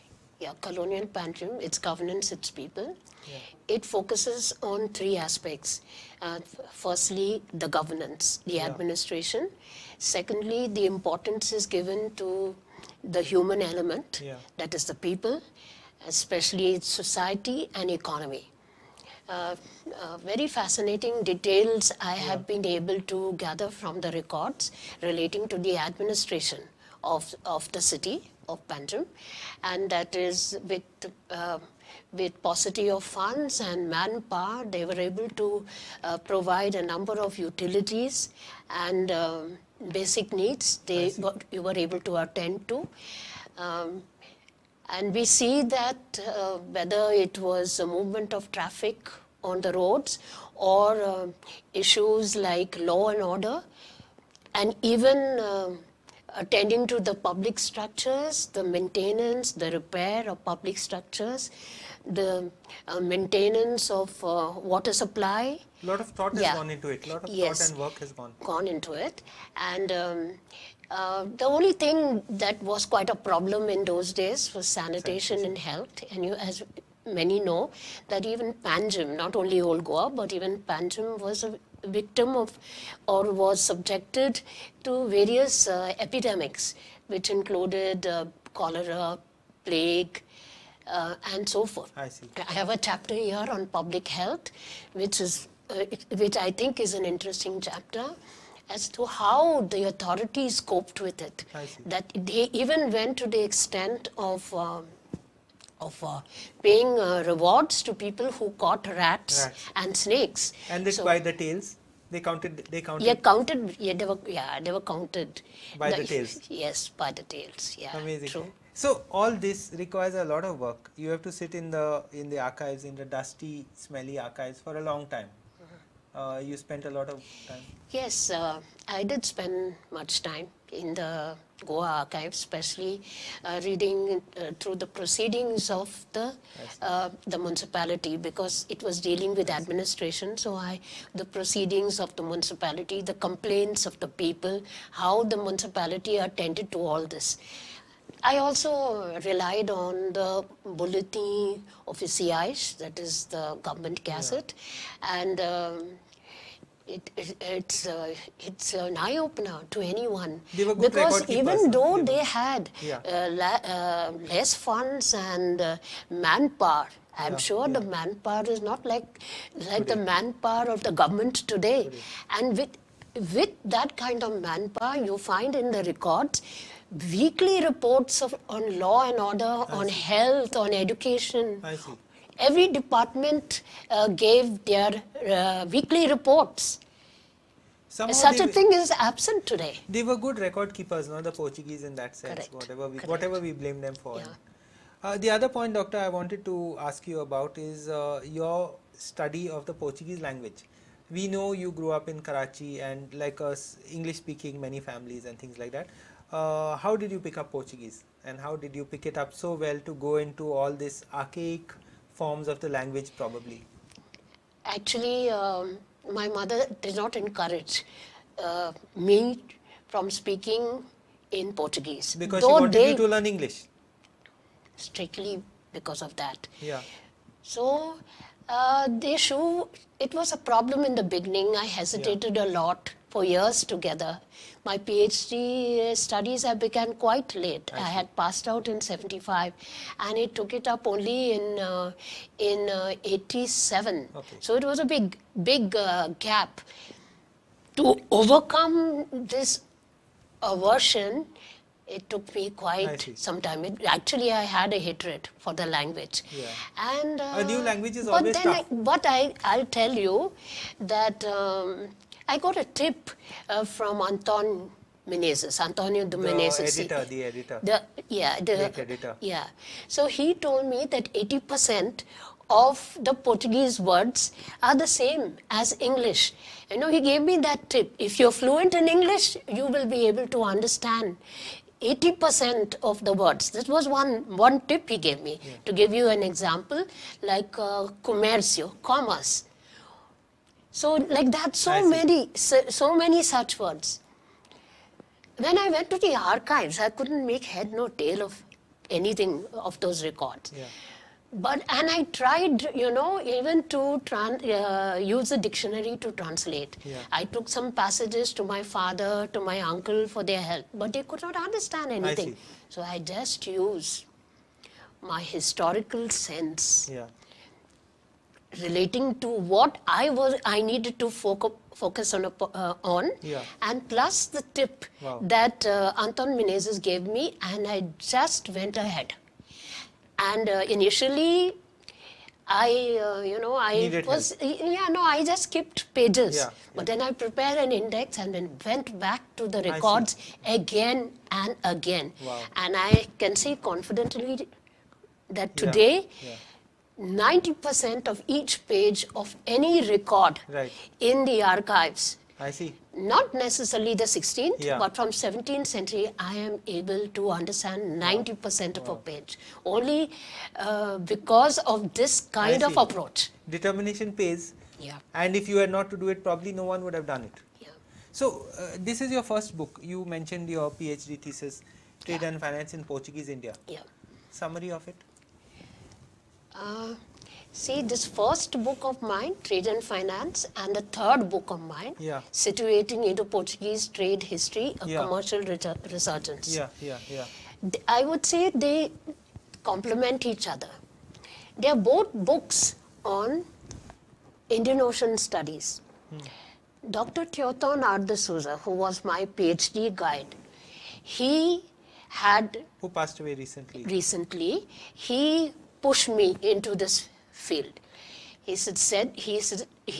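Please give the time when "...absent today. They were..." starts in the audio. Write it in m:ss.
3:08.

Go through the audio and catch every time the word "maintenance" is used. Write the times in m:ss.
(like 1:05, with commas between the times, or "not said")
0:58, 1:02.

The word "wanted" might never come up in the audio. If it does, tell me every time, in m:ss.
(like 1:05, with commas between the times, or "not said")
3:16, 3:42.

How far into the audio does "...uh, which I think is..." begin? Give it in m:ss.
1:35.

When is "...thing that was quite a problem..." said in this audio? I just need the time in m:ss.
1:11.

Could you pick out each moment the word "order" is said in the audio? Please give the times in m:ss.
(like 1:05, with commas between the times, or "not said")
0:53, 2:59.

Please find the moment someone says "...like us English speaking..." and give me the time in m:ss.
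3:23.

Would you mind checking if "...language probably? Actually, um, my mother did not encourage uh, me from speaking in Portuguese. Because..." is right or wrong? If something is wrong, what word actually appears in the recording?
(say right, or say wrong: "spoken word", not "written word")
right.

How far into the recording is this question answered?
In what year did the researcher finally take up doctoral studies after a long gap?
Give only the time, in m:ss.
4:03.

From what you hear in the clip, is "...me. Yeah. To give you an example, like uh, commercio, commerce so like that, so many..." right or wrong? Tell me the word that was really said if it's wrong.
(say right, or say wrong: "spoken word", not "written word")
right.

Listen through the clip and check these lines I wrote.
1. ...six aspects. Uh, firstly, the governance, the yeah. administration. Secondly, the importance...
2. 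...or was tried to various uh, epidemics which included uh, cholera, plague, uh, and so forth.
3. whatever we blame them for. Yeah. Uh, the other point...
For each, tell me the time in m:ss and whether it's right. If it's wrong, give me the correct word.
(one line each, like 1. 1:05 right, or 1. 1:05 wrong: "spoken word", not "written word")
1. 0:04 wrong: "three", not "six"
2. 1:23 wrong: "subjected", not "tried"
3. 3:13 right.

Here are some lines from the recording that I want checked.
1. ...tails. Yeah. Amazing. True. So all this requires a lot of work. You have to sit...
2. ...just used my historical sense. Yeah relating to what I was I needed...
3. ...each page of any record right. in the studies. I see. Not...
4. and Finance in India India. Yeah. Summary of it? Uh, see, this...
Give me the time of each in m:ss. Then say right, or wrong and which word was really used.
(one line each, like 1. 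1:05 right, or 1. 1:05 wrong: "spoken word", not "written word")
1. 1:57 right
2. 5:12 right
3. 5:48 wrong: "archives", not "studies"
4. 6:12 wrong: "Portuguese", not "India".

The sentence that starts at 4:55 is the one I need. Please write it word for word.
When I went to the archives, I couldn't make head nor tail of anything of those records.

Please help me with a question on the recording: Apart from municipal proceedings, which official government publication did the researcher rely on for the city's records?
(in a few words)
bulletin officiais.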